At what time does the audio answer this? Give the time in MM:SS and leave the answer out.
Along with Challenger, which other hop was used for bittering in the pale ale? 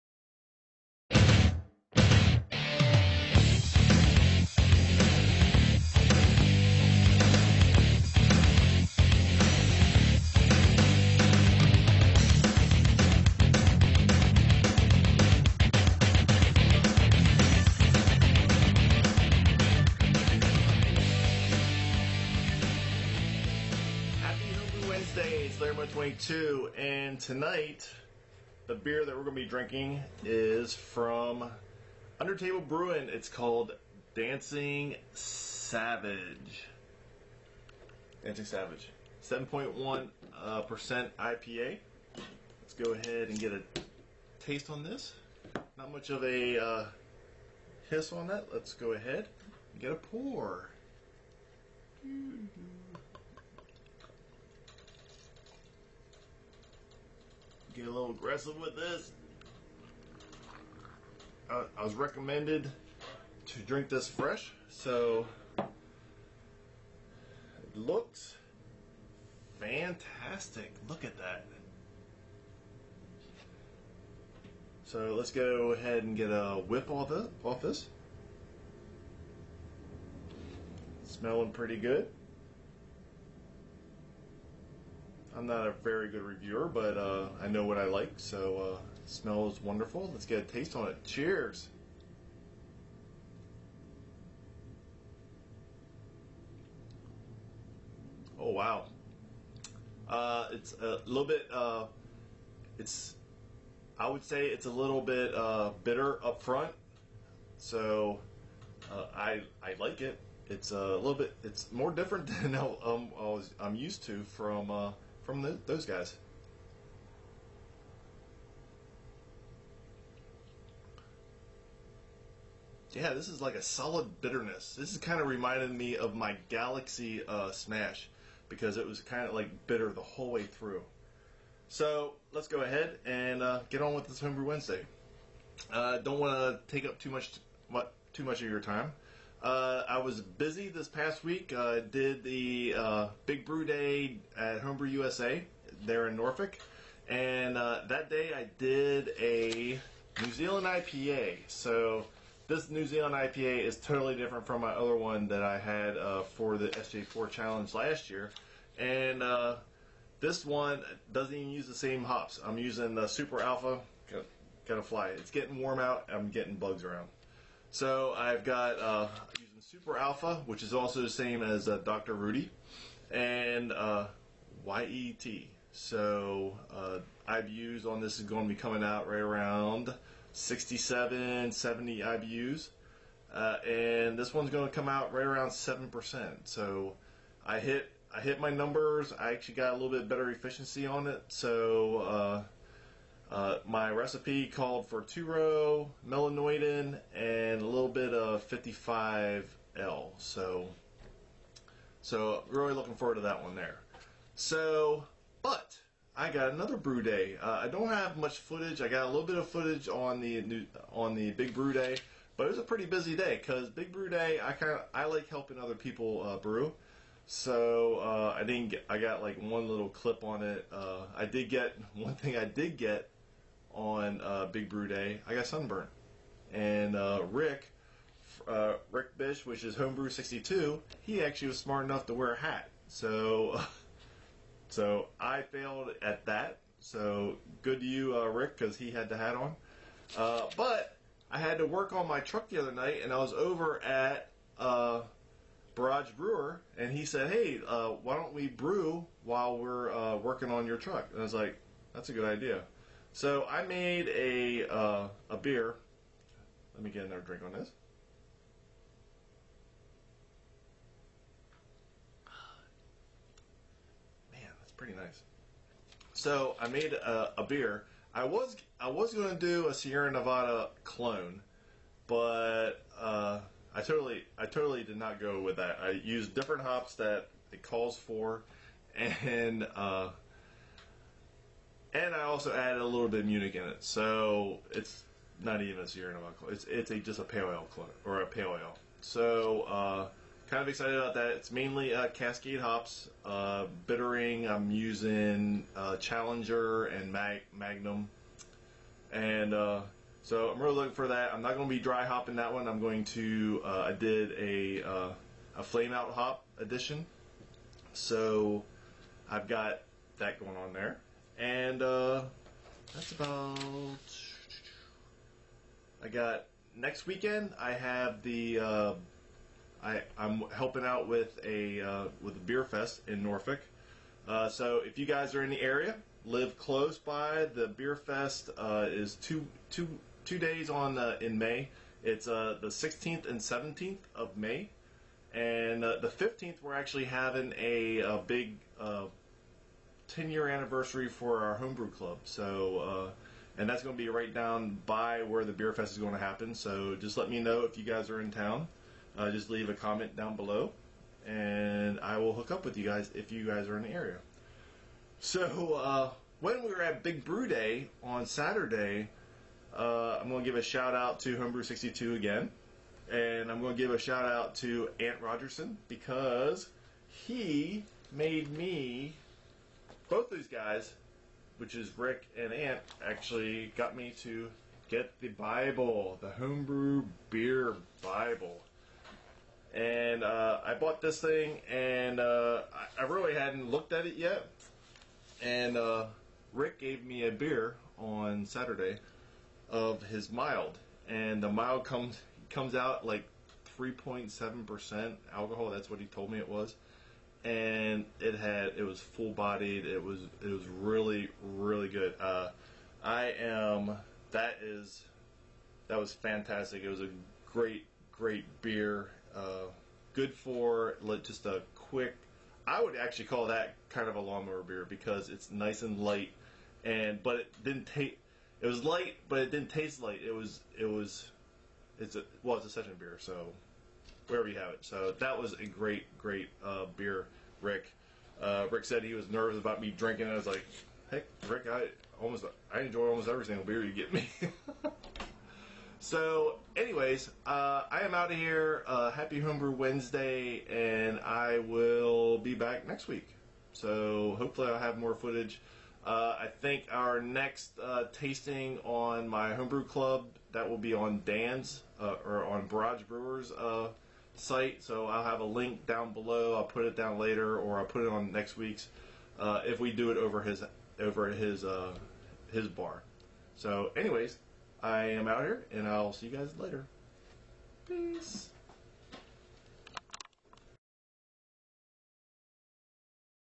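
04:57.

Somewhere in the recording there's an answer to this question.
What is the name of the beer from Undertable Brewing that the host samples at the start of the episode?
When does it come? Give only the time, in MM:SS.
00:33.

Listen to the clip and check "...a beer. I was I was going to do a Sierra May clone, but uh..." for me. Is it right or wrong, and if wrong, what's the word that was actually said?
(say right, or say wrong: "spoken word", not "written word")
wrong: "Nevada", not "May".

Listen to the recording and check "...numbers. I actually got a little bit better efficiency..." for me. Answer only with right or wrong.
right.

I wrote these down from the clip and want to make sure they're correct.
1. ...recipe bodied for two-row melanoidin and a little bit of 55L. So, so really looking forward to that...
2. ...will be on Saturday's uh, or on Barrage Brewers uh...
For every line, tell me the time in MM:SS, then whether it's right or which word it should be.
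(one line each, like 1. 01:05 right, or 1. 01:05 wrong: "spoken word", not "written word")
1. 03:14 wrong: "called", not "bodied"
2. 07:30 wrong: "Dan", not "Saturday".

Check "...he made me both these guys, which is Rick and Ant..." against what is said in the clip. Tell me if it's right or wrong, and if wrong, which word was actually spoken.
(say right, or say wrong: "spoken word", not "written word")
right.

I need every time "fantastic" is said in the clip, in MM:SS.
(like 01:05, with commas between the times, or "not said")
01:09, 06:46.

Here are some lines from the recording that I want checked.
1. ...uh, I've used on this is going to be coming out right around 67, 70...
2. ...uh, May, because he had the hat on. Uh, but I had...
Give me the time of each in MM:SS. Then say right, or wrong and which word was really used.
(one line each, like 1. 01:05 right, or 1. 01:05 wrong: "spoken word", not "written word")
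1. 02:56 right
2. 03:58 wrong: "Rick", not "May".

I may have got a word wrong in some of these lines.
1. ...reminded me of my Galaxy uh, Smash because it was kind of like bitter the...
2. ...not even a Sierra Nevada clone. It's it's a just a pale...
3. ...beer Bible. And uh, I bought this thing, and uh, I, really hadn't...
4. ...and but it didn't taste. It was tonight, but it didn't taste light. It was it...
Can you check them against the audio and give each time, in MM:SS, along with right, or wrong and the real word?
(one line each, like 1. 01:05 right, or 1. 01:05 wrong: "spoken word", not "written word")
1. 02:05 right
2. 04:45 right
3. 06:17 right
4. 06:56 wrong: "light", not "tonight".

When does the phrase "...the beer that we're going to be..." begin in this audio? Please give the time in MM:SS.
00:28.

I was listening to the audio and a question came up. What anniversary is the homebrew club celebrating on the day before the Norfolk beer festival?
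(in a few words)
10 year anniversary.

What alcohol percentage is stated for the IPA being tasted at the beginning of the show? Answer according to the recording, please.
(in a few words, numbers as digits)
7.1%.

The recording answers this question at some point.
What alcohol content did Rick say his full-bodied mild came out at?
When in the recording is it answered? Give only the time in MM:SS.
06:33.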